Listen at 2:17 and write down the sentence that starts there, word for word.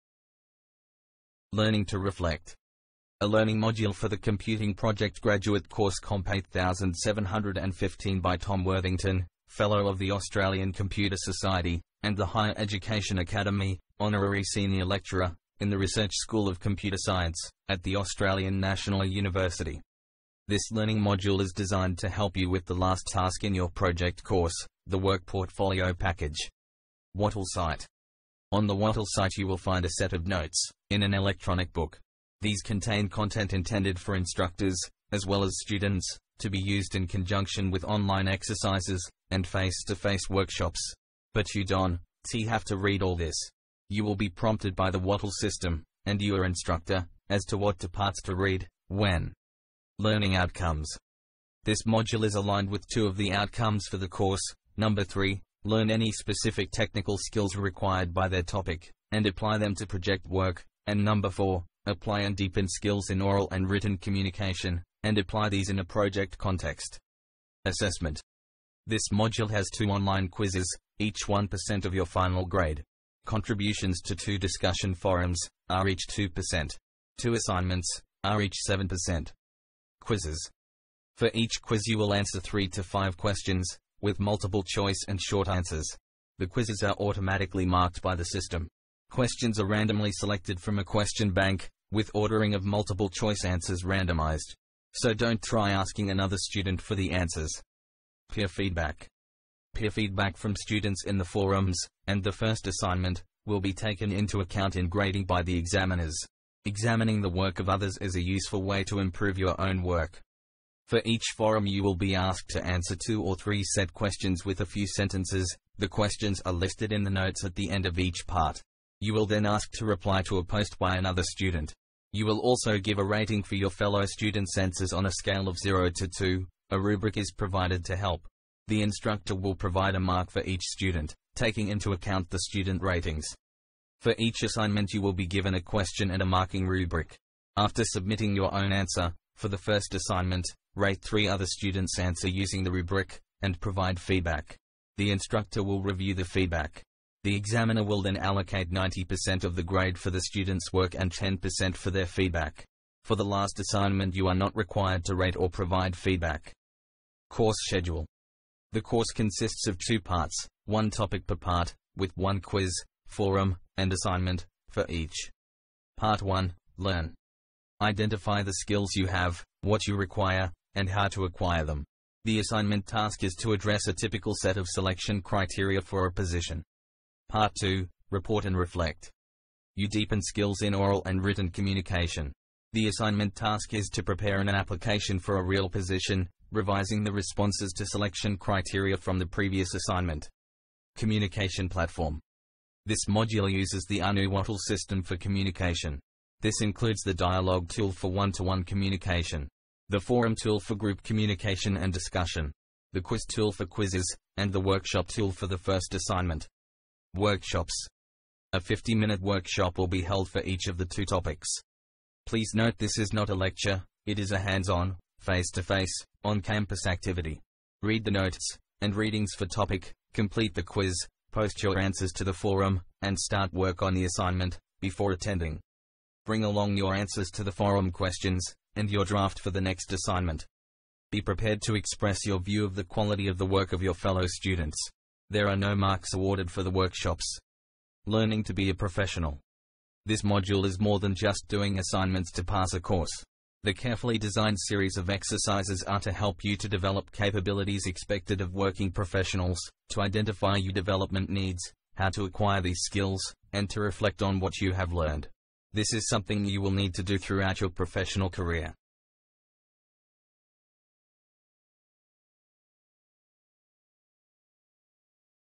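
After submitting your own answer, for the first assignment, Rate three other students' answer using the rubric, and provide feedback.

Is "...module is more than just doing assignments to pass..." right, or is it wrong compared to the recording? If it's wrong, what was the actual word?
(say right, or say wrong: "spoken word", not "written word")
right.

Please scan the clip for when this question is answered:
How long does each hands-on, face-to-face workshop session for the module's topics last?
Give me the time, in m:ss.
3:28.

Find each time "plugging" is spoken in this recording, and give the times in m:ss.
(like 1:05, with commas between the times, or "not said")
not said.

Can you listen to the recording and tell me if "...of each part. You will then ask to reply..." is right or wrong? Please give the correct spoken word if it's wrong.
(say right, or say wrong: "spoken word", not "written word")
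right.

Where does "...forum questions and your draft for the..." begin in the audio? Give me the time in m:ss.
3:47.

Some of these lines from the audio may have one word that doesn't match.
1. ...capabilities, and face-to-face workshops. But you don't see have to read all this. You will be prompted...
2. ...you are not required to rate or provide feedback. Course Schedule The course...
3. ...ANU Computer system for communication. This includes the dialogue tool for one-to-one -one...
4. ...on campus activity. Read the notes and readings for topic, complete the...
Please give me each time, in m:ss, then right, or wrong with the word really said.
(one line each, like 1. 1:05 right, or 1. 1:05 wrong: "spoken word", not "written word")
1. 0:38 wrong: "exercises", not "capabilities"
2. 2:34 right
3. 3:14 wrong: "Wattle", not "Computer"
4. 3:36 right.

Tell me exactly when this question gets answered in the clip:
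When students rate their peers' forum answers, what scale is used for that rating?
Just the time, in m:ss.
2:05.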